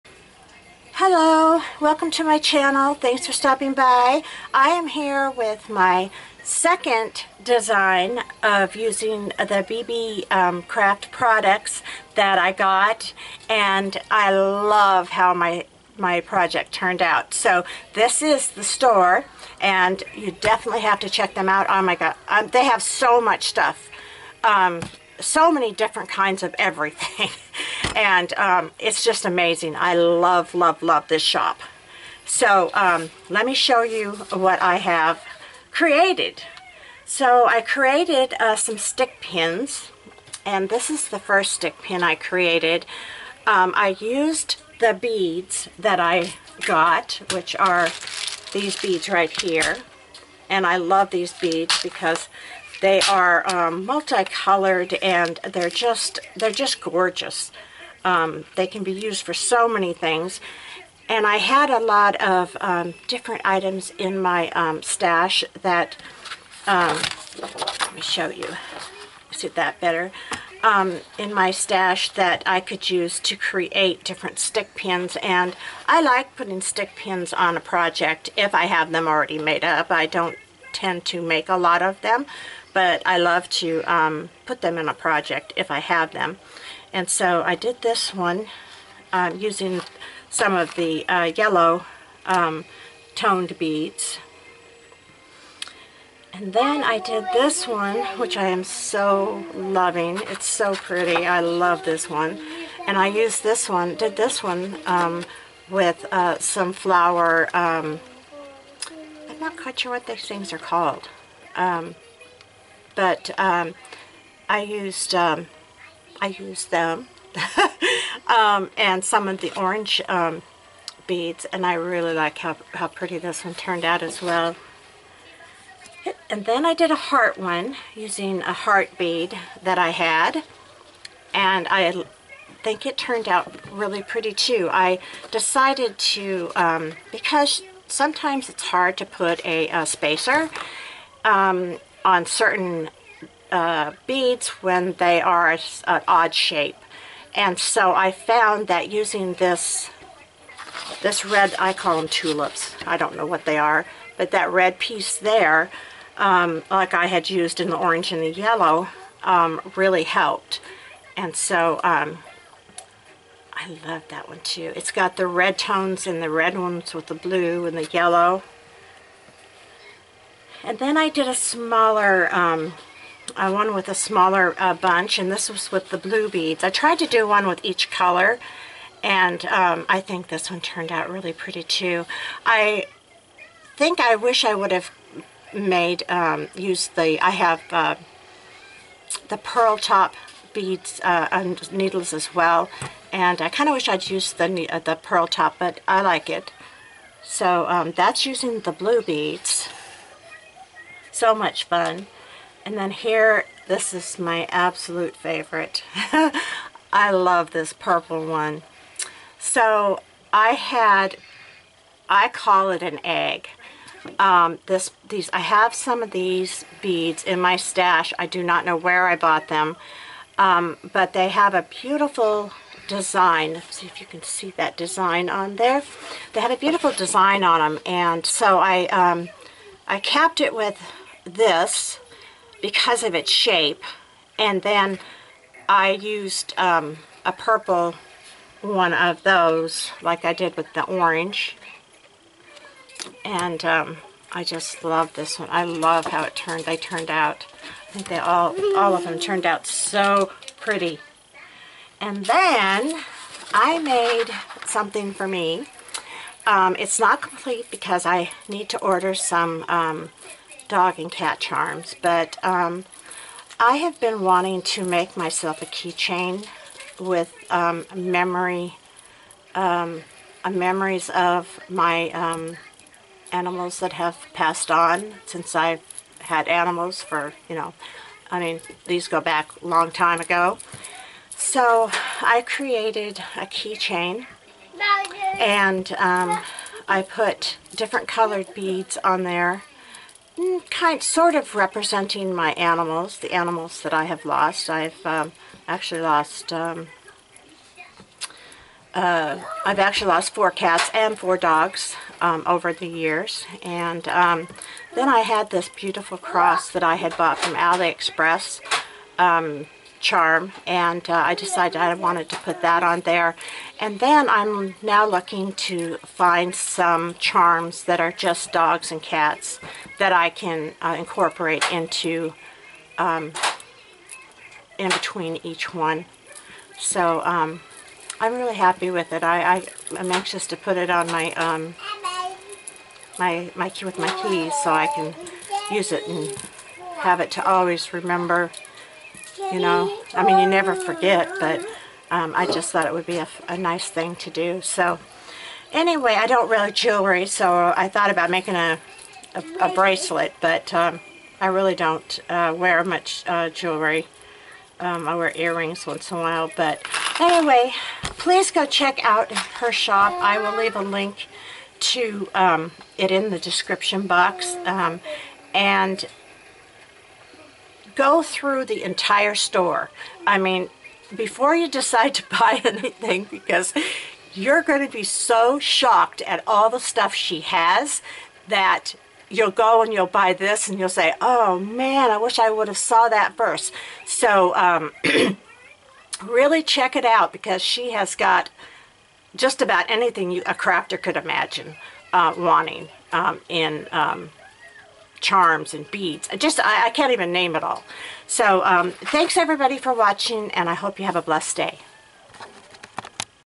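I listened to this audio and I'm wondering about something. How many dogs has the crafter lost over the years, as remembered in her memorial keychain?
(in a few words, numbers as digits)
4.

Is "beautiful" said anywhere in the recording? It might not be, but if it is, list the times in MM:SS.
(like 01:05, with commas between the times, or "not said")
03:41, 03:46, 05:05.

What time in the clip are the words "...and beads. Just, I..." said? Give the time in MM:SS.
06:35.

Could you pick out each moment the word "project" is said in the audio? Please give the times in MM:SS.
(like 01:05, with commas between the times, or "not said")
00:16, 01:17, 01:24.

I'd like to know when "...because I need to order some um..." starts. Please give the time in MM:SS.
04:17.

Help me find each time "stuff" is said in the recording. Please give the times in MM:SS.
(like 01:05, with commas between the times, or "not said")
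00:23, 06:16.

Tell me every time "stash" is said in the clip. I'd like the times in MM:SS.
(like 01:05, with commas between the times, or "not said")
01:04, 01:11, 03:37.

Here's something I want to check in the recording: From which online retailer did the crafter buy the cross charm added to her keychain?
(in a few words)
AliExpress.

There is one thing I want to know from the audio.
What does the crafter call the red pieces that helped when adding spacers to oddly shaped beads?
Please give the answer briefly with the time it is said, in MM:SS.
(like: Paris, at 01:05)
Tulips, at 02:32.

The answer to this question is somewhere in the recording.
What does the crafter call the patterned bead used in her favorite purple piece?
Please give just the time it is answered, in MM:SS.
03:32.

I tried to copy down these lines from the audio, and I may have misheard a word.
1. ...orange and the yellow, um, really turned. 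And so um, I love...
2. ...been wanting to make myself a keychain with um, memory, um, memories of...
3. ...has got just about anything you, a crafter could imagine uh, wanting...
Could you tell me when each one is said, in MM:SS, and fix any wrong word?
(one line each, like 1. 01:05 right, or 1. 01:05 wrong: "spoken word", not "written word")
1. 02:37 wrong: "helped", not "turned"
2. 04:23 right
3. 06:27 right.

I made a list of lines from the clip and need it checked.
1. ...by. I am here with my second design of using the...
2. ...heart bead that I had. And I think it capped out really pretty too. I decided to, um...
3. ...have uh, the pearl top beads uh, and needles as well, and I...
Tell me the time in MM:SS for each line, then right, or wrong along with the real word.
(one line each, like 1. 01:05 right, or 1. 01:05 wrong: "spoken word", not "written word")
1. 00:03 right
2. 02:08 wrong: "turned", not "capped"
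3. 03:07 right.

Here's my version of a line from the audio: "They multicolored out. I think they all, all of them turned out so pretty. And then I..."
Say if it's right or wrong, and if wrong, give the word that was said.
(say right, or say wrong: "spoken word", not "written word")
wrong: "turned", not "multicolored".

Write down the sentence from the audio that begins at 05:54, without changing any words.
Um, I wear earrings once in a while, but anyway, please go check out her shop.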